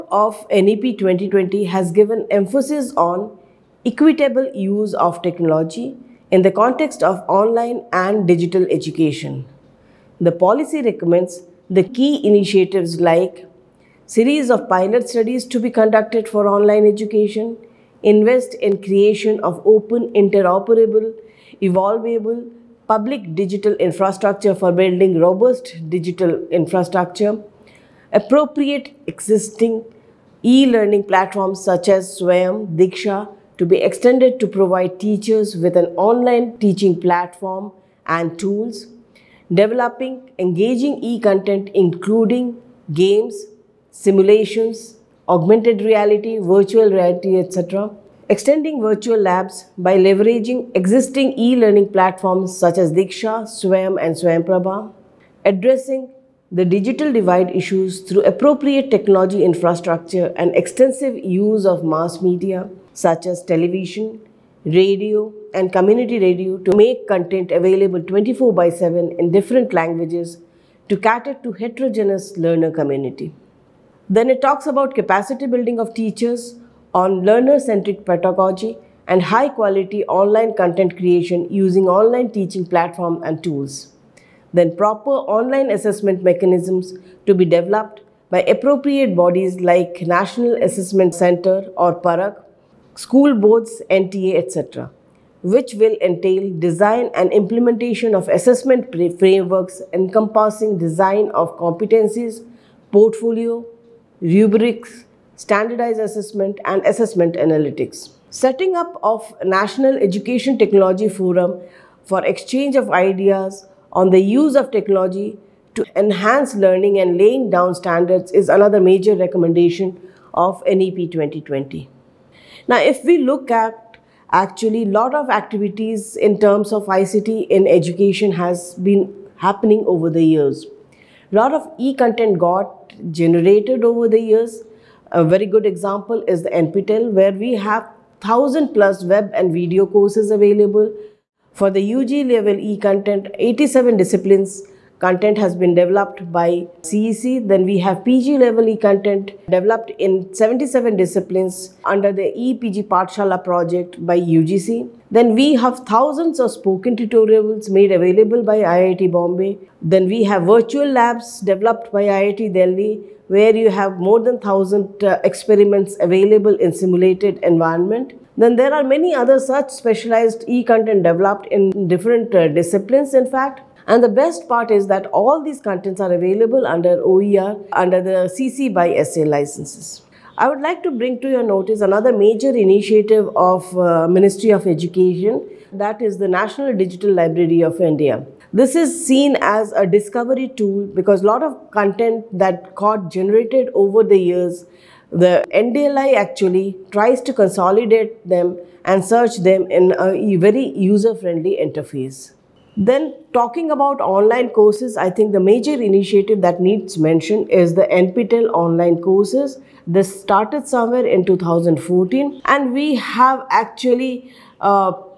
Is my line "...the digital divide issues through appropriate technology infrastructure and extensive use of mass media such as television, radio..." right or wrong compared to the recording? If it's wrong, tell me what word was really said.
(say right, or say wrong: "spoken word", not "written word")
right.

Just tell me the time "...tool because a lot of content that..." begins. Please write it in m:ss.
3:10.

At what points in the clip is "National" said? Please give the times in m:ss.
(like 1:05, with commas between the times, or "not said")
1:30, 1:49, 3:06.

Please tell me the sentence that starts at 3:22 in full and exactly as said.
Then talking about online courses, I think the major initiative that needs mention is the NPTEL online courses.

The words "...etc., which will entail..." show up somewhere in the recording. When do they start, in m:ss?
1:34.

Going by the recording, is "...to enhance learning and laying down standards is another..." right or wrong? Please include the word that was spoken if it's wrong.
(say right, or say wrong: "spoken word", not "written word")
right.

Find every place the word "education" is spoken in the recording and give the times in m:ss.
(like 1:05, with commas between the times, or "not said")
0:08, 0:16, 1:49, 2:07, 3:04.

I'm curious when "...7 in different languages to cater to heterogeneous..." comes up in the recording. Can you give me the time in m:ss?
1:08.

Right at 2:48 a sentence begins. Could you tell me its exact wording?
Then there are many other such specialized e-content developed in different uh, disciplines in fact.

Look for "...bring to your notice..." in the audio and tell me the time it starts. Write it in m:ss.
3:00.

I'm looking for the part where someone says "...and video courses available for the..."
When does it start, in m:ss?
2:19.